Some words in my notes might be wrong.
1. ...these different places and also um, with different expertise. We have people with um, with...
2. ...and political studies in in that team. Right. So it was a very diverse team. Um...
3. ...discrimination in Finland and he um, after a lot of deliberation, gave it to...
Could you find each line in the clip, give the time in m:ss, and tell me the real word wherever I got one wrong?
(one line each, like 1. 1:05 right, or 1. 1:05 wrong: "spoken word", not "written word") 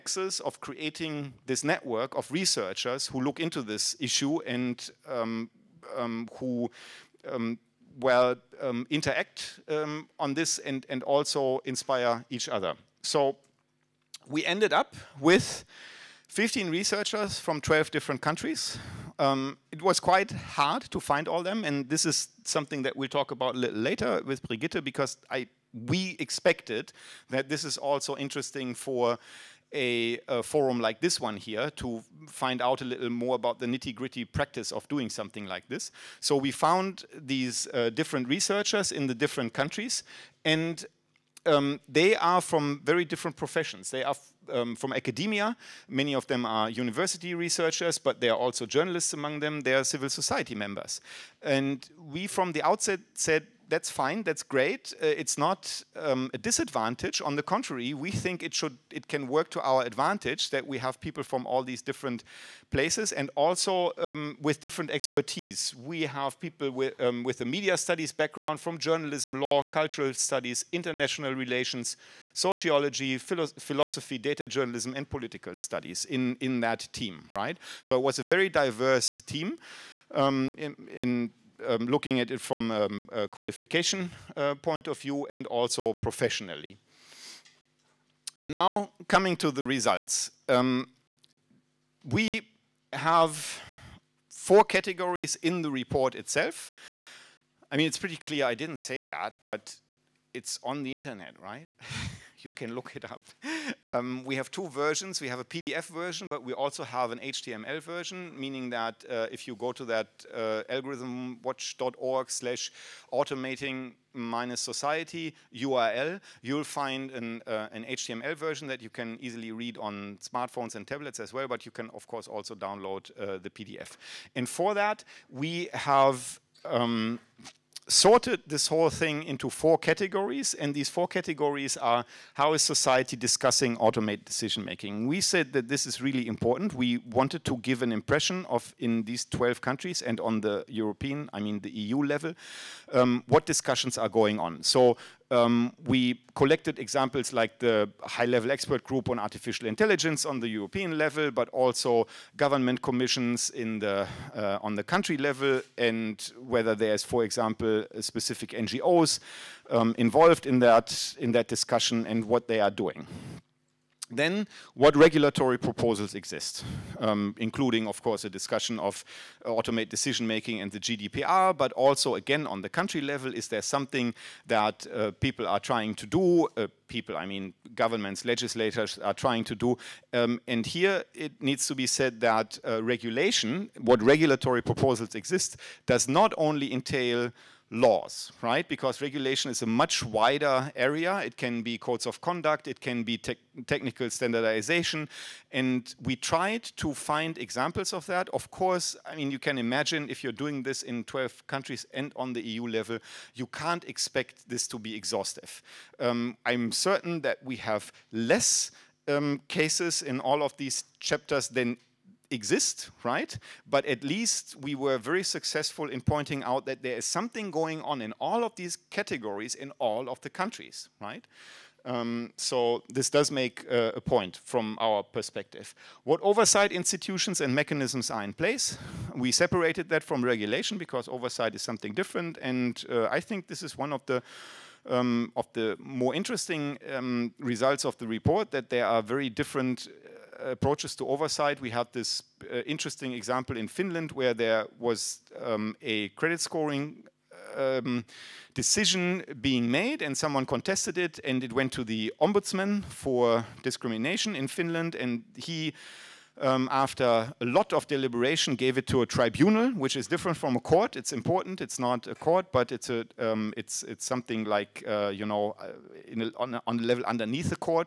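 1. 1:01 right
2. 1:14 right
3. 4:13 right.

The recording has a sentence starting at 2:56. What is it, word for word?
Uh, people, I mean, governments, legislators are trying to do.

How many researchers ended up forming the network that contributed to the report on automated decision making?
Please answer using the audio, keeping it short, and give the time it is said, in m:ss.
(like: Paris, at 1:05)
15, at 0:16.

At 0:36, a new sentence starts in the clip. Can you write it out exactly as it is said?
So we found these uh, different researchers in the different countries and um, they are from very different professions.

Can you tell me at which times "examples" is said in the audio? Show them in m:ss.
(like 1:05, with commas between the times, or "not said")
2:26, 2:37, 3:17, 4:03.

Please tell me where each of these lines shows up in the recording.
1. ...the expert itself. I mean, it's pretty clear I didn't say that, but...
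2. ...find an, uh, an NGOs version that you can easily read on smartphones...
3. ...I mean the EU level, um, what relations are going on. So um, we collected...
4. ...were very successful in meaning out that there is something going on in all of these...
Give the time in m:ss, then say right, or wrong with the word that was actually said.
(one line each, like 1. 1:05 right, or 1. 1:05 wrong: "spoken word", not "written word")
1. 1:35 wrong: "report", not "expert"
2. 1:56 wrong: "HTML", not "NGOs"
3. 2:21 wrong: "discussions", not "relations"
4. 3:34 wrong: "pointing", not "meaning".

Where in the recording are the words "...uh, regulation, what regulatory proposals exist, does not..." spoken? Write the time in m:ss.
3:02.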